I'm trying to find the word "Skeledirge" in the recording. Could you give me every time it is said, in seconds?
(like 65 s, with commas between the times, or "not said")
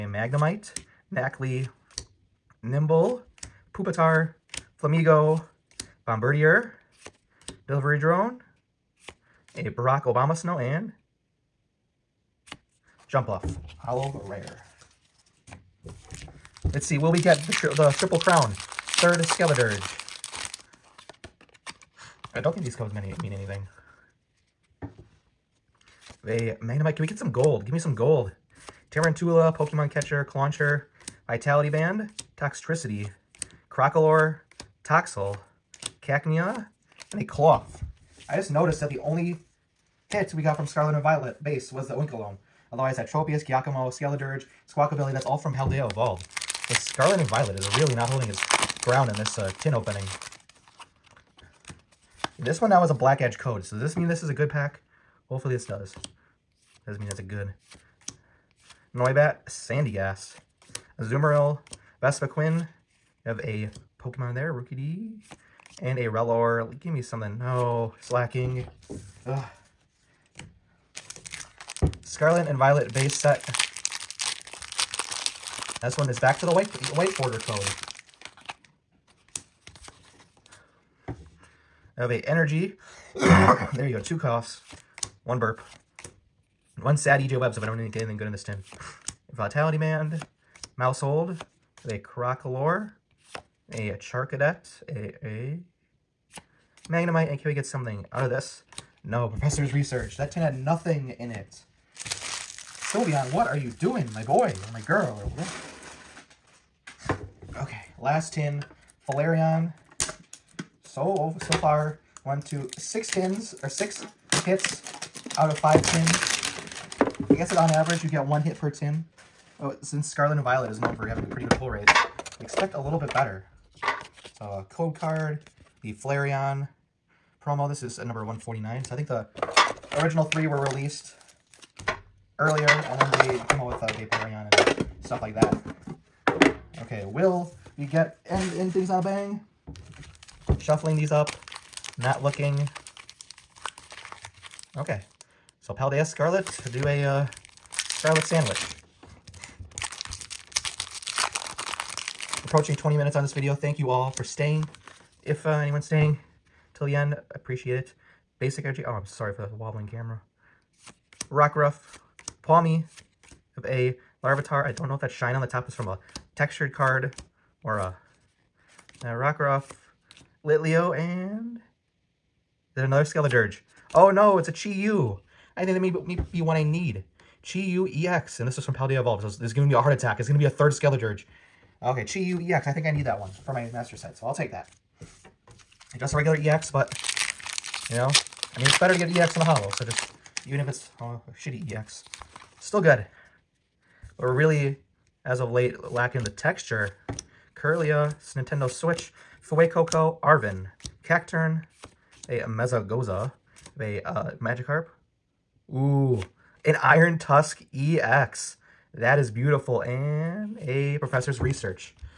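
19 s, 43 s, 173 s, 180 s.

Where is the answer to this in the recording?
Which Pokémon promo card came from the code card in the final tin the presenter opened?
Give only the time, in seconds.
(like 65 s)
125 s.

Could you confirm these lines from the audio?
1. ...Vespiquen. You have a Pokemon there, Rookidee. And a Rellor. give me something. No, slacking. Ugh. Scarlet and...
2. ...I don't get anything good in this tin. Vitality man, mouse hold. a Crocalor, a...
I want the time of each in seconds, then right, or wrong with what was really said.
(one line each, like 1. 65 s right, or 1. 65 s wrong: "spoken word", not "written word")
1. 62 s right
2. 87 s right.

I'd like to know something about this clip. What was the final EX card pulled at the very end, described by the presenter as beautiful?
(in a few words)
Iron Tusk EX.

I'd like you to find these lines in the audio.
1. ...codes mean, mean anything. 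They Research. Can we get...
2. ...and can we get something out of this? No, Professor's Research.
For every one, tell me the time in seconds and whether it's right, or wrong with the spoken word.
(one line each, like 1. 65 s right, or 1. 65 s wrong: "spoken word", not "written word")
1. 22 s wrong: "Magnemite", not "Research"
2. 97 s right.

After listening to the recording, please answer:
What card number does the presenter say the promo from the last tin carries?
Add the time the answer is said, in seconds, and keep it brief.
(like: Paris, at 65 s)
149, at 128 s.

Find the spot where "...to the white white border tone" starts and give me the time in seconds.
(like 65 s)
76 s.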